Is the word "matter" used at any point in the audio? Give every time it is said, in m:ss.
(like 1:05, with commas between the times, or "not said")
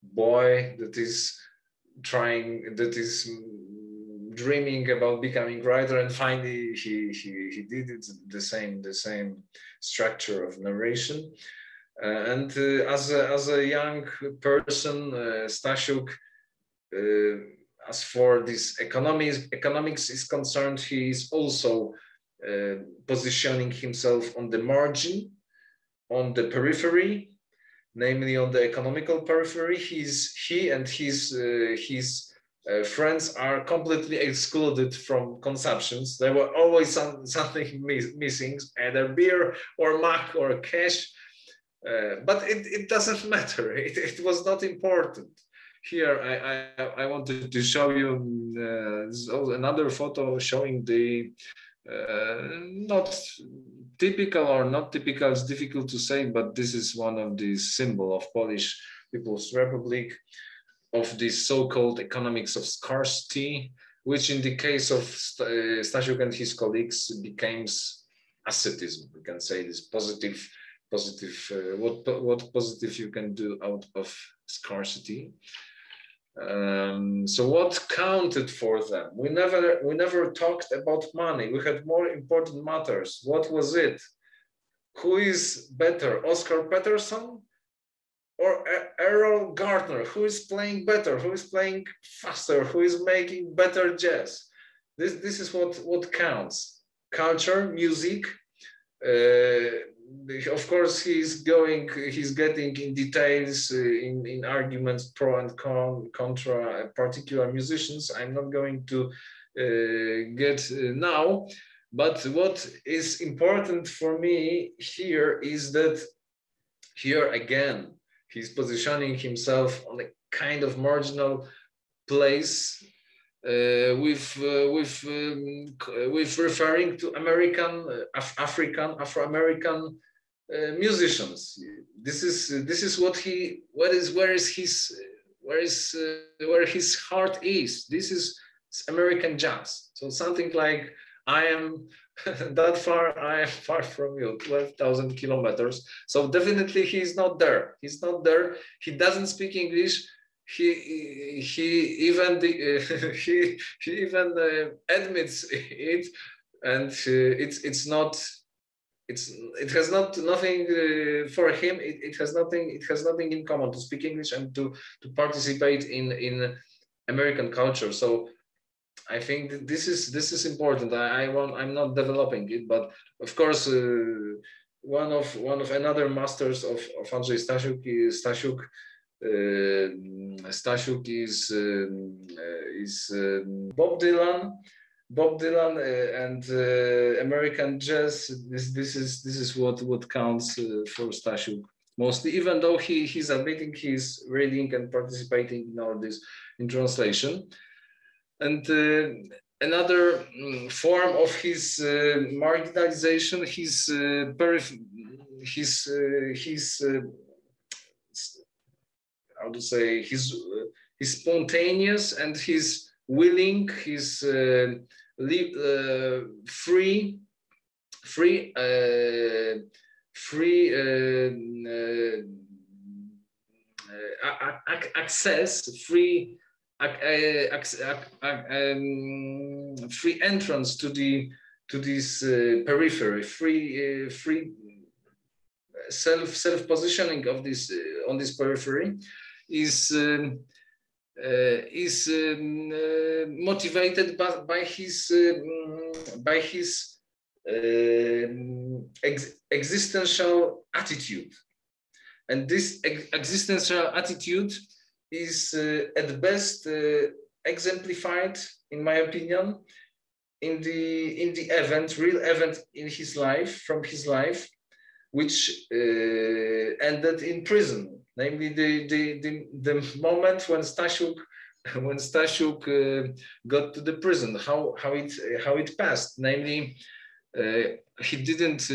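0:43, 1:22.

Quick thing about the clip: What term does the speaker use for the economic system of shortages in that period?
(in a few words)
economics of scarcity.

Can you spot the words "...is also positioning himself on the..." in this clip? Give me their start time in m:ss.
0:21.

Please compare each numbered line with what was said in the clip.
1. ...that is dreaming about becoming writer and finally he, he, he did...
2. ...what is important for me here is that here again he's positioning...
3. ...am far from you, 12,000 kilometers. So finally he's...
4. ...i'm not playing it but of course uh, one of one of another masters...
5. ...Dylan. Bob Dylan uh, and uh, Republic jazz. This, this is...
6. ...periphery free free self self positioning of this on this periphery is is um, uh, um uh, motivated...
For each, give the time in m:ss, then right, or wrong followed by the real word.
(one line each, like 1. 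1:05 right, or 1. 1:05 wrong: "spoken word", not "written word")
1. 0:02 right
2. 1:52 right
3. 2:23 wrong: "definitely", not "finally"
4. 2:51 wrong: "developing", not "playing"
5. 3:03 wrong: "American", not "Republic"
6. 3:52 right.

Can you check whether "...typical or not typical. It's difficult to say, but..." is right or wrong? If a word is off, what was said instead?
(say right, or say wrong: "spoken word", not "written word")
right.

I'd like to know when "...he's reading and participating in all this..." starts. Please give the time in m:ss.
3:13.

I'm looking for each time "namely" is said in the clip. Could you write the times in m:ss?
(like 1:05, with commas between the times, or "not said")
0:27, 4:28, 4:36.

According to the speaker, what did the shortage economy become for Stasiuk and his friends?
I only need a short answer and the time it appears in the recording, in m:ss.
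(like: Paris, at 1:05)
ascetism, at 1:08.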